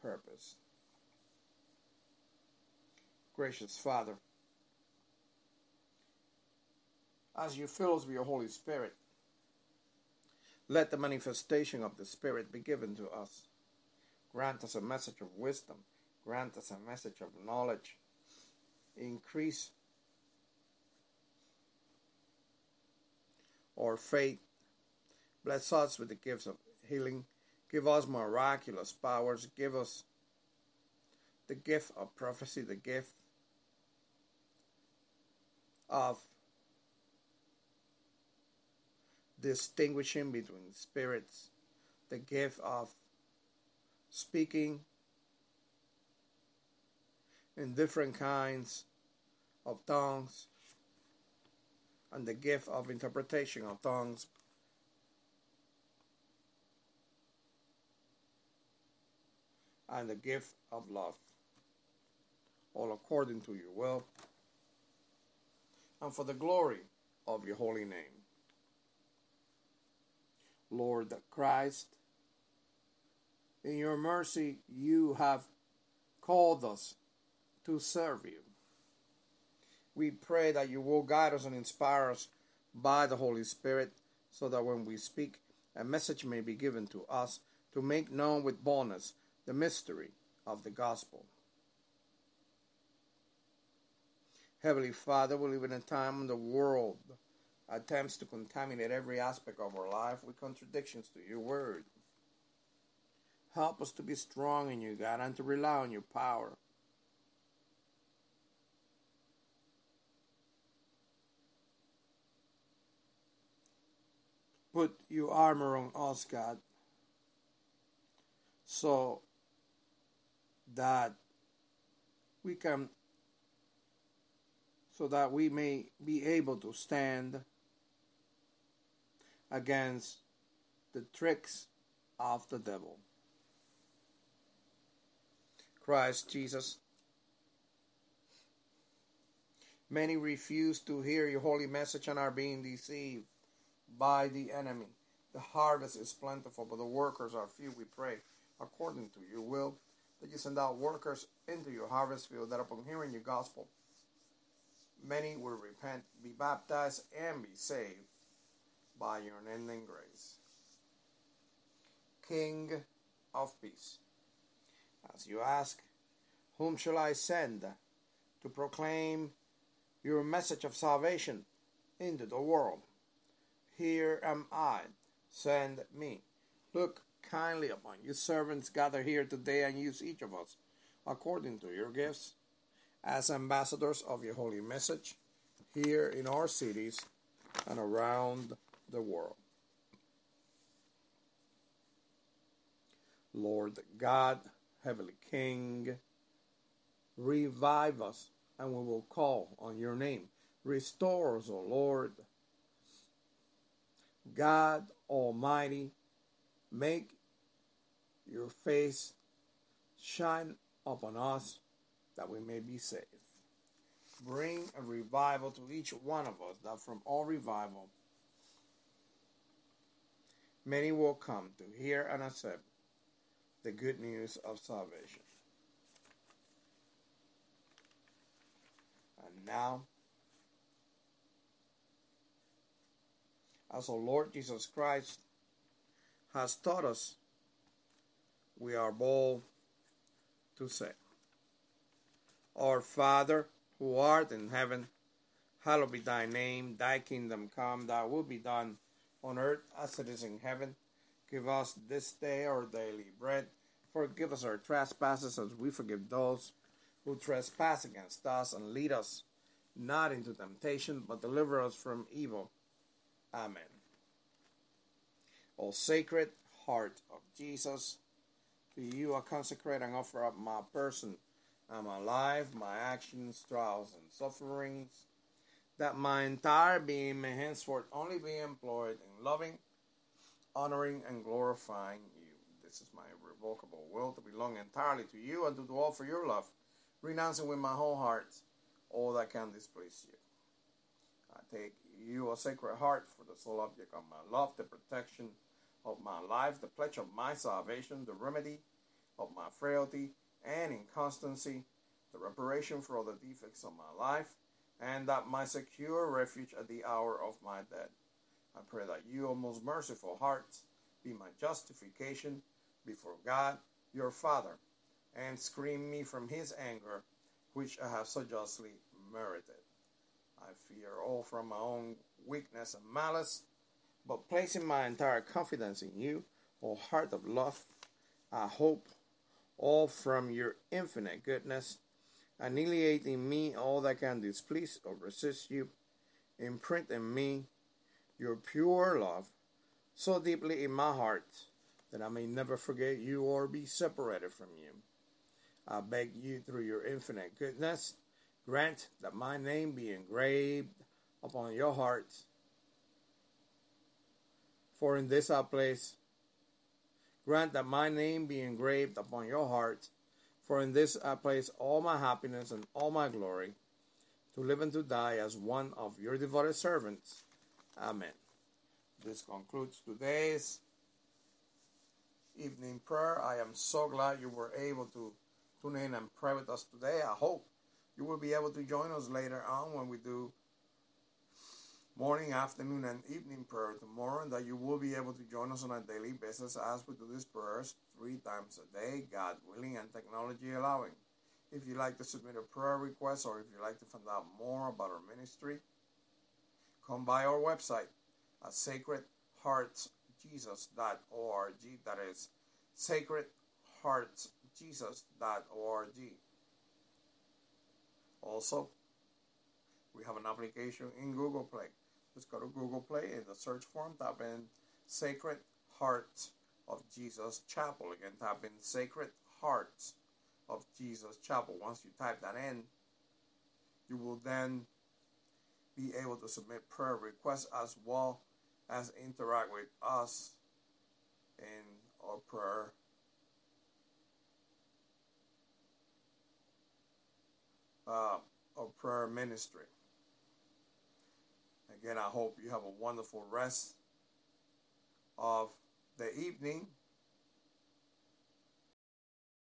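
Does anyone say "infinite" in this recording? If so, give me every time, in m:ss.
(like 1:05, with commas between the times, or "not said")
5:30, 5:46.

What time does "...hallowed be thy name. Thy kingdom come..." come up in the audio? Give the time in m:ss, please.
4:05.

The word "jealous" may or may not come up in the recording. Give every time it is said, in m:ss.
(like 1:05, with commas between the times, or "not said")
not said.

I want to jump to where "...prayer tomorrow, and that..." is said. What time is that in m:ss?
6:23.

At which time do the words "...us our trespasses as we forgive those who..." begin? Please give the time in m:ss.
4:14.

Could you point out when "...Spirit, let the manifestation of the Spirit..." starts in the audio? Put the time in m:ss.
0:08.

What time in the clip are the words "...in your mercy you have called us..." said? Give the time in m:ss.
1:13.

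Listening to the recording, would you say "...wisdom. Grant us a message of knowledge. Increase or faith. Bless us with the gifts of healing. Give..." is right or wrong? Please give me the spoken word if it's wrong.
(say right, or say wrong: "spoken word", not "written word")
right.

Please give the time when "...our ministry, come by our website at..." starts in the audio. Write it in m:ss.
6:34.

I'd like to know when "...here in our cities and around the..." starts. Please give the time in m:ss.
3:05.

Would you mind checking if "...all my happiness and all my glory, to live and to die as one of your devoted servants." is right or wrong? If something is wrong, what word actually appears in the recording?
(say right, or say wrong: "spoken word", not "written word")
right.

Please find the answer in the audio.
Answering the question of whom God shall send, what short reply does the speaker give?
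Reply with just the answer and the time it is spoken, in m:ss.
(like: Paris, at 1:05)
Here am I, send me, at 2:53.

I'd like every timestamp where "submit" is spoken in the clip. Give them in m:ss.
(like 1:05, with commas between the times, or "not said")
6:32, 7:06.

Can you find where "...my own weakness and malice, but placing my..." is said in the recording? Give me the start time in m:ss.
5:21.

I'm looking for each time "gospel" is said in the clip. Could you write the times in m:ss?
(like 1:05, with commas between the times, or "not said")
1:30, 2:33.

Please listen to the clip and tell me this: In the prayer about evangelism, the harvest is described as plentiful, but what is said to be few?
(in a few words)
The workers.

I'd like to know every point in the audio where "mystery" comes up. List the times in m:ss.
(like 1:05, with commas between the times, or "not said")
1:29.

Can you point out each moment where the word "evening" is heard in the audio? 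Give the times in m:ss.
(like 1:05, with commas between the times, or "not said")
6:12, 6:23, 7:26.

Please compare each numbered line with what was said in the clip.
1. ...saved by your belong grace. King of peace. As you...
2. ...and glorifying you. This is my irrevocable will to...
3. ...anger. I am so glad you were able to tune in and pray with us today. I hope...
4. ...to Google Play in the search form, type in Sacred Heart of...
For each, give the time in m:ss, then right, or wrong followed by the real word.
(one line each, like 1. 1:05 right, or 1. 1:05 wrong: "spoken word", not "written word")
1. 2:37 wrong: "unending", not "belong"
2. 4:41 right
3. 6:12 wrong: "prayer", not "anger"
4. 6:52 right.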